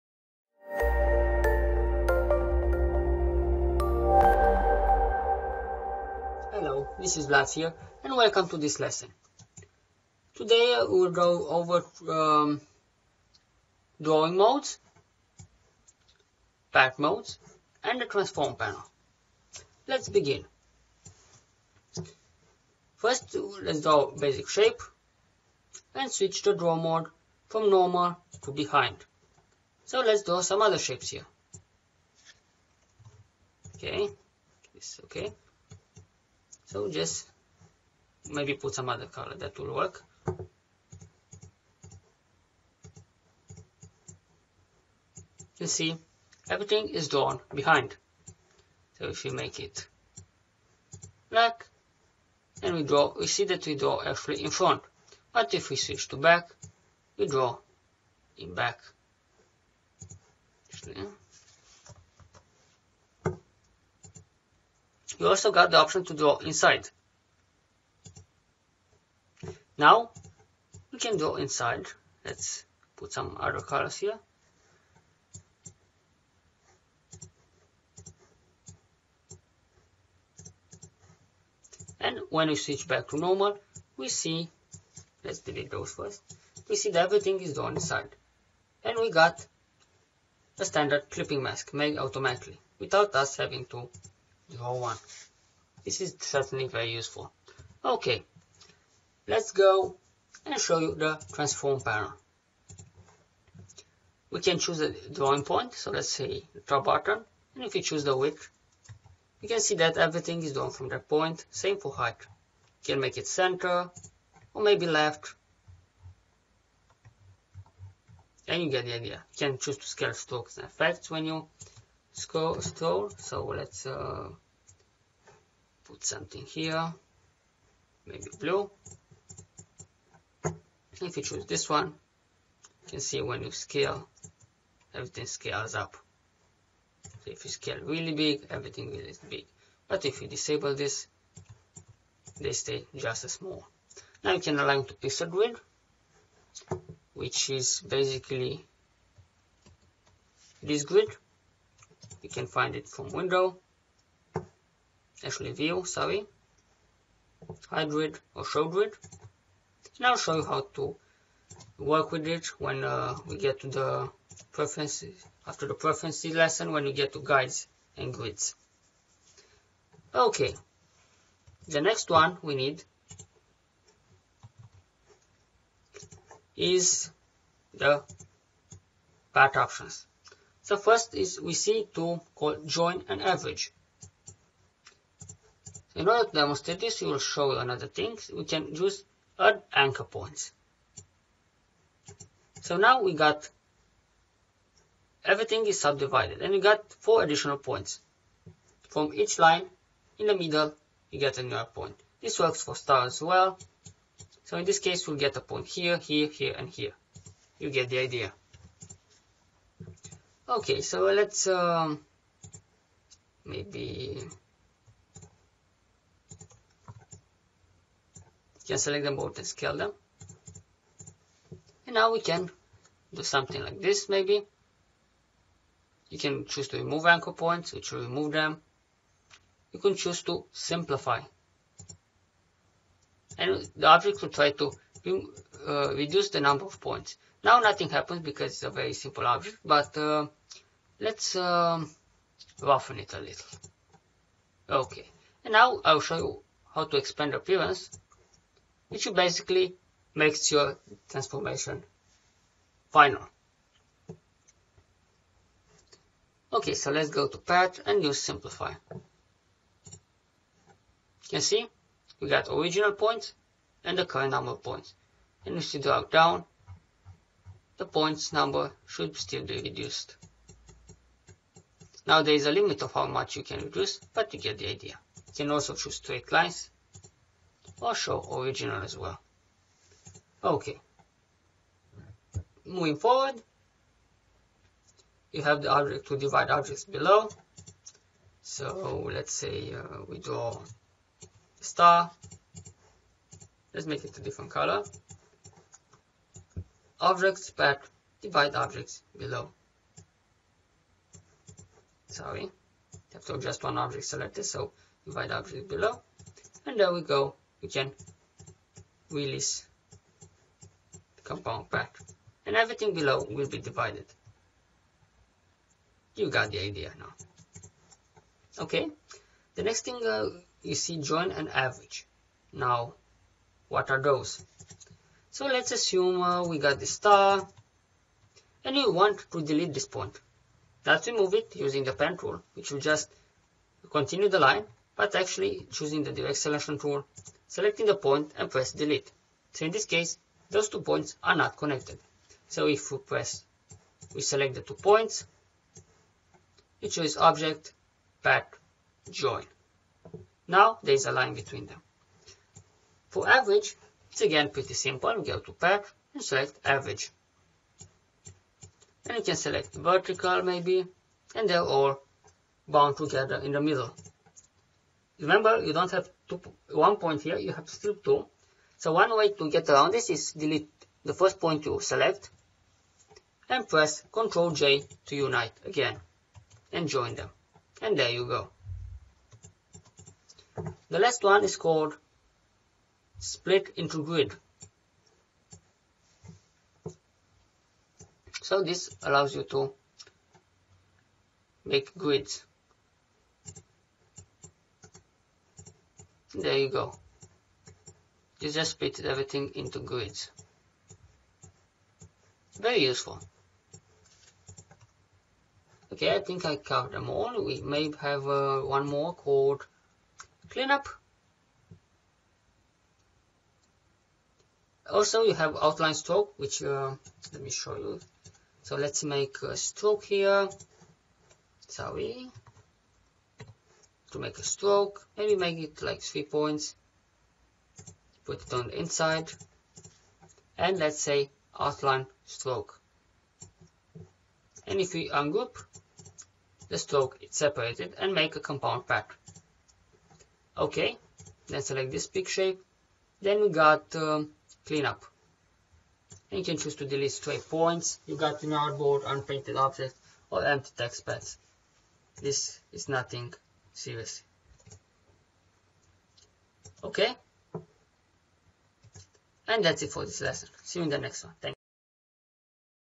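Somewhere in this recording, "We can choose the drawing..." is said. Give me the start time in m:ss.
1:44.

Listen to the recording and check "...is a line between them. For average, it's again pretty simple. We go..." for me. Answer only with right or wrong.
right.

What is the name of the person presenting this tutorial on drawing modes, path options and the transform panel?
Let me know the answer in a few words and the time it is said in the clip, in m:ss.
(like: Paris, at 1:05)
Vlad, at 0:07.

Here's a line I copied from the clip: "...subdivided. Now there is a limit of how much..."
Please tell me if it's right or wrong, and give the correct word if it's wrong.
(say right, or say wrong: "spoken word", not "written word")
wrong: "reduced", not "subdivided".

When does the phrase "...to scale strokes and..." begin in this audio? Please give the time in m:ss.
1:59.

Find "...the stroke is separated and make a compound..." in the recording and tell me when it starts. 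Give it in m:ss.
7:16.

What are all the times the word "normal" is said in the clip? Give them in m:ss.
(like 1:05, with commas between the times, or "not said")
0:27, 1:23.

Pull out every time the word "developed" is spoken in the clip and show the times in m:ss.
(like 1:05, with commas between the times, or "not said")
not said.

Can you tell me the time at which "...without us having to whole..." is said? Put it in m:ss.
1:32.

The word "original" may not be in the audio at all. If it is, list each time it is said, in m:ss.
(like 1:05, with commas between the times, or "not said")
4:22, 4:38.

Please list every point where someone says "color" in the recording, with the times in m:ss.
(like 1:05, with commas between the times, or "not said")
0:39, 1:13, 4:54.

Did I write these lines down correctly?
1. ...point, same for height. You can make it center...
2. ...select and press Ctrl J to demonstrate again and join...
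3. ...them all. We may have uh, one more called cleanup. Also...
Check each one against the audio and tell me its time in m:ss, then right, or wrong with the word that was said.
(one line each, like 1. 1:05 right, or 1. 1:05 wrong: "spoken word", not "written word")
1. 1:51 right
2. 6:11 wrong: "unite", not "demonstrate"
3. 6:46 right.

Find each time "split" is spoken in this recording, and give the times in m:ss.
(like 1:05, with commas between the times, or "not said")
6:23, 6:38.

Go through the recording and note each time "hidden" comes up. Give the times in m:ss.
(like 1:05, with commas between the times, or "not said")
not said.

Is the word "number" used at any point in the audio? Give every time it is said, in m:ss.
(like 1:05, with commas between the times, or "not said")
3:56, 4:24, 4:28.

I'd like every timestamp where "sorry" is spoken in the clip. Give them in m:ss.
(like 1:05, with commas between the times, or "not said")
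2:35, 5:02, 7:01.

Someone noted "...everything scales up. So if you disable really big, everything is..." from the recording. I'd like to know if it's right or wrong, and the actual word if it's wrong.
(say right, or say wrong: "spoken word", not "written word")
wrong: "scale", not "disable".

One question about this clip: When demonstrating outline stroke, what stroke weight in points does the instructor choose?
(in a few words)
3.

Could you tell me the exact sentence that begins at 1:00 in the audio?
Actually, You also got the option to draw inside.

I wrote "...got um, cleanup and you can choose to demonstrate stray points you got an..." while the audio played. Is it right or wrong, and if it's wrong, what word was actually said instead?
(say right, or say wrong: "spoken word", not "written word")
wrong: "delete", not "demonstrate".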